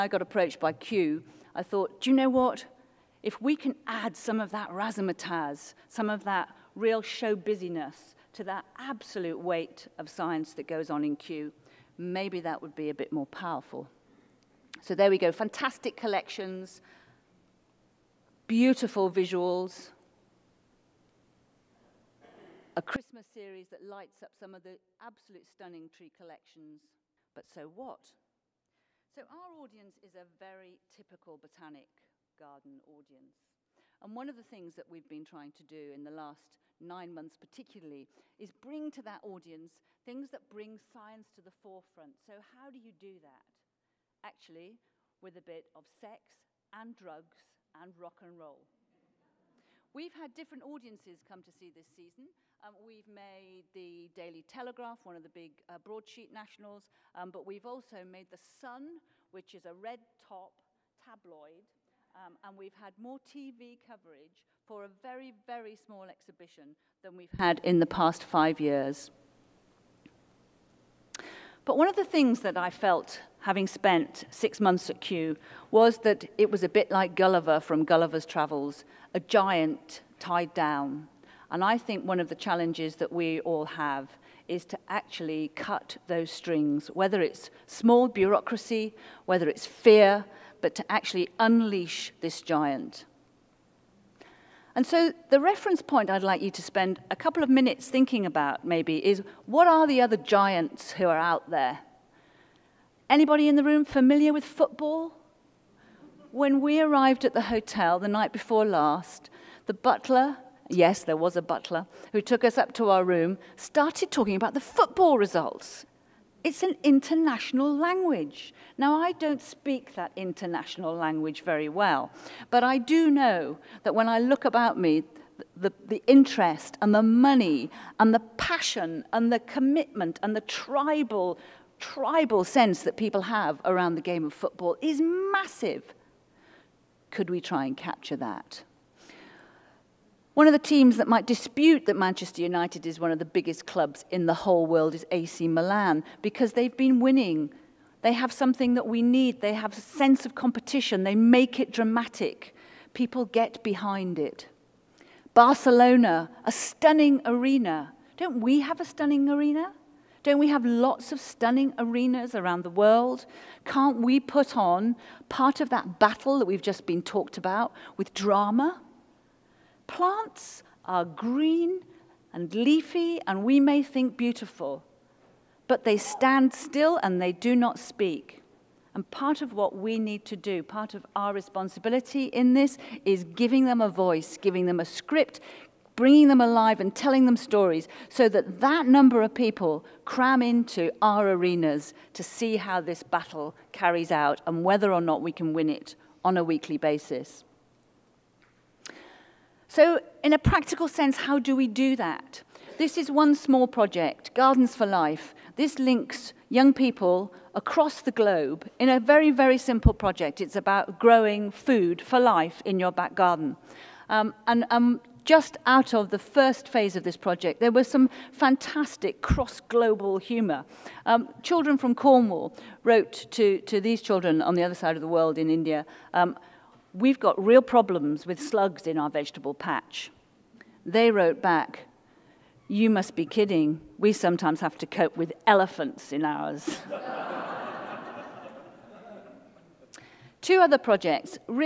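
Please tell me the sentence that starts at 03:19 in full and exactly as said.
So in a practical sense, how do we do that?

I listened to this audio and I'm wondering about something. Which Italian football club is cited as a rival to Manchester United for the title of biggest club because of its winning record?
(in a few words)
AC Milan.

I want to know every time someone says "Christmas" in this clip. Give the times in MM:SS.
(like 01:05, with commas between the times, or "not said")
00:22.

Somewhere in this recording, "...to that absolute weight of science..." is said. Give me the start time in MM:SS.
00:08.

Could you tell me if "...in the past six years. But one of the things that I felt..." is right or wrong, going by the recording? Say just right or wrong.
wrong.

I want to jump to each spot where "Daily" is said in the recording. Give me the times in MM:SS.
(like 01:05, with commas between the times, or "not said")
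00:54.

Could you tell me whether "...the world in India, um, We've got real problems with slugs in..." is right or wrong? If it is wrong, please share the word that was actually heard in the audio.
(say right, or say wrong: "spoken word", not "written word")
right.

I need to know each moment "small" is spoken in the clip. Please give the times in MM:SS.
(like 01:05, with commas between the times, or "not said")
01:05, 01:27, 03:23.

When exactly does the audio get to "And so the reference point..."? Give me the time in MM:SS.
01:34.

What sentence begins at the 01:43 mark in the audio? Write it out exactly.
Anybody in the room familiar with football?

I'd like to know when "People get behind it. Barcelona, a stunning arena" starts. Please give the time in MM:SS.
02:32.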